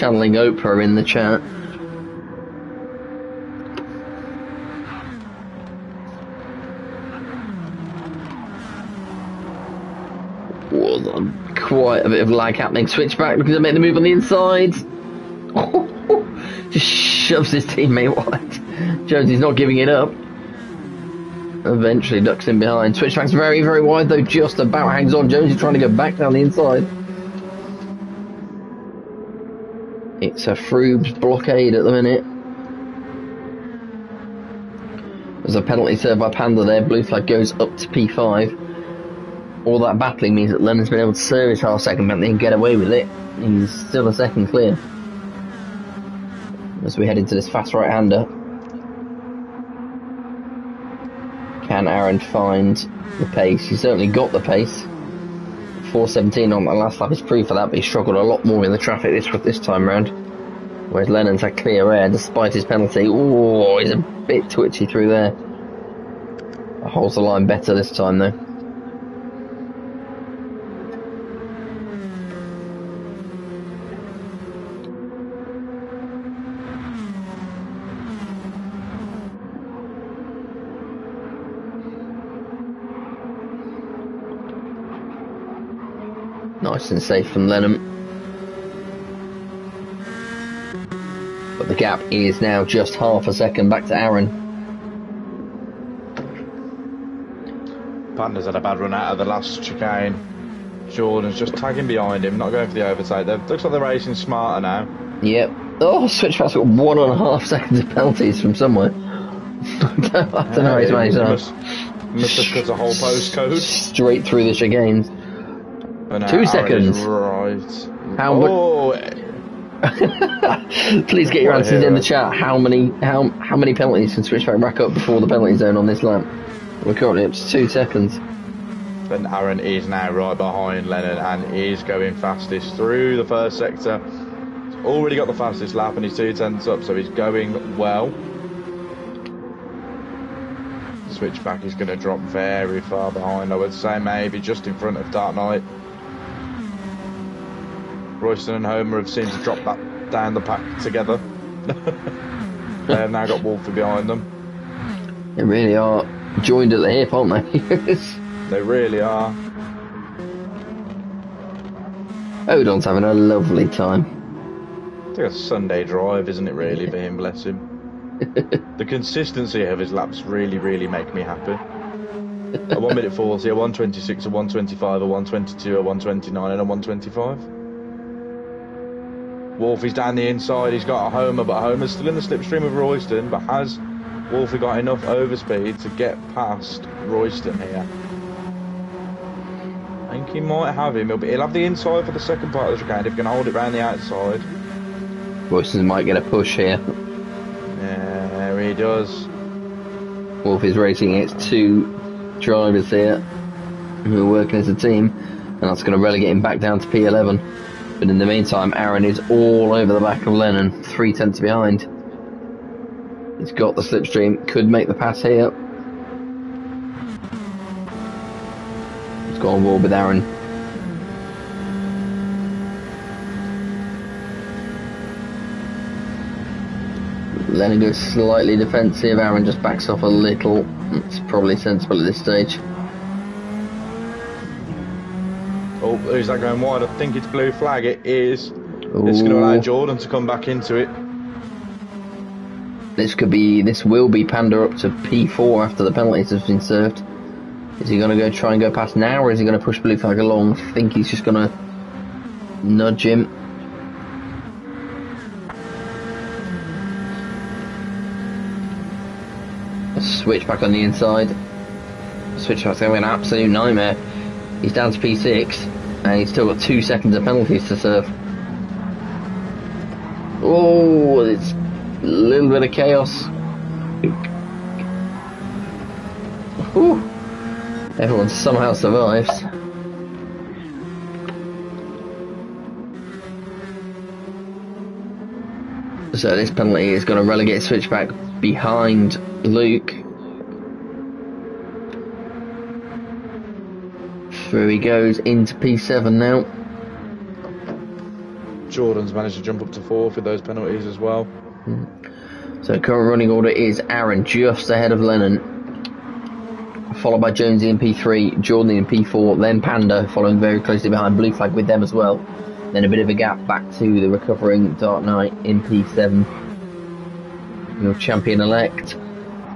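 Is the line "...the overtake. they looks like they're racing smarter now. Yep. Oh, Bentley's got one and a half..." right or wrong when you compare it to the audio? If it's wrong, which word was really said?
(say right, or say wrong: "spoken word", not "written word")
wrong: "Switchback", not "Bentley".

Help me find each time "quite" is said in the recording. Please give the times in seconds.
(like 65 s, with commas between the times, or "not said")
11 s.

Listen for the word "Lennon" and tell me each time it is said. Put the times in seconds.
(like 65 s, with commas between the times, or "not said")
40 s, 61 s, 87 s, 130 s, 210 s, 227 s, 304 s.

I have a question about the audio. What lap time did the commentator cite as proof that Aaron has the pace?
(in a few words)
4.17.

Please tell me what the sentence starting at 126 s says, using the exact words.
We're currently up to two seconds.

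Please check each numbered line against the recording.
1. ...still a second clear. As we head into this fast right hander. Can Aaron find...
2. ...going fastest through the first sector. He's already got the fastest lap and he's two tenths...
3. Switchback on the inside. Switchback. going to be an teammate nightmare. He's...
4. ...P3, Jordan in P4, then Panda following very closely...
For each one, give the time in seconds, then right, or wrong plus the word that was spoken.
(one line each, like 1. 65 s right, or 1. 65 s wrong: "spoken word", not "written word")
1. 43 s right
2. 131 s right
3. 259 s wrong: "absolute", not "teammate"
4. 307 s right.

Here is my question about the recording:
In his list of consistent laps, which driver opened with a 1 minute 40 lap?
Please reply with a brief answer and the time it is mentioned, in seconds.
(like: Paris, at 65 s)
Odon, at 162 s.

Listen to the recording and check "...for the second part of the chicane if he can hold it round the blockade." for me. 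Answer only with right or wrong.
wrong.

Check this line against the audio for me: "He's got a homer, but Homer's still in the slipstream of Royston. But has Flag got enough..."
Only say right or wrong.
wrong.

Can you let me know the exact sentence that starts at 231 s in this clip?
It's probably sensible at this stage.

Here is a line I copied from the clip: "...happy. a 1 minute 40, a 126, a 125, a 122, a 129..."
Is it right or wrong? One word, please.
right.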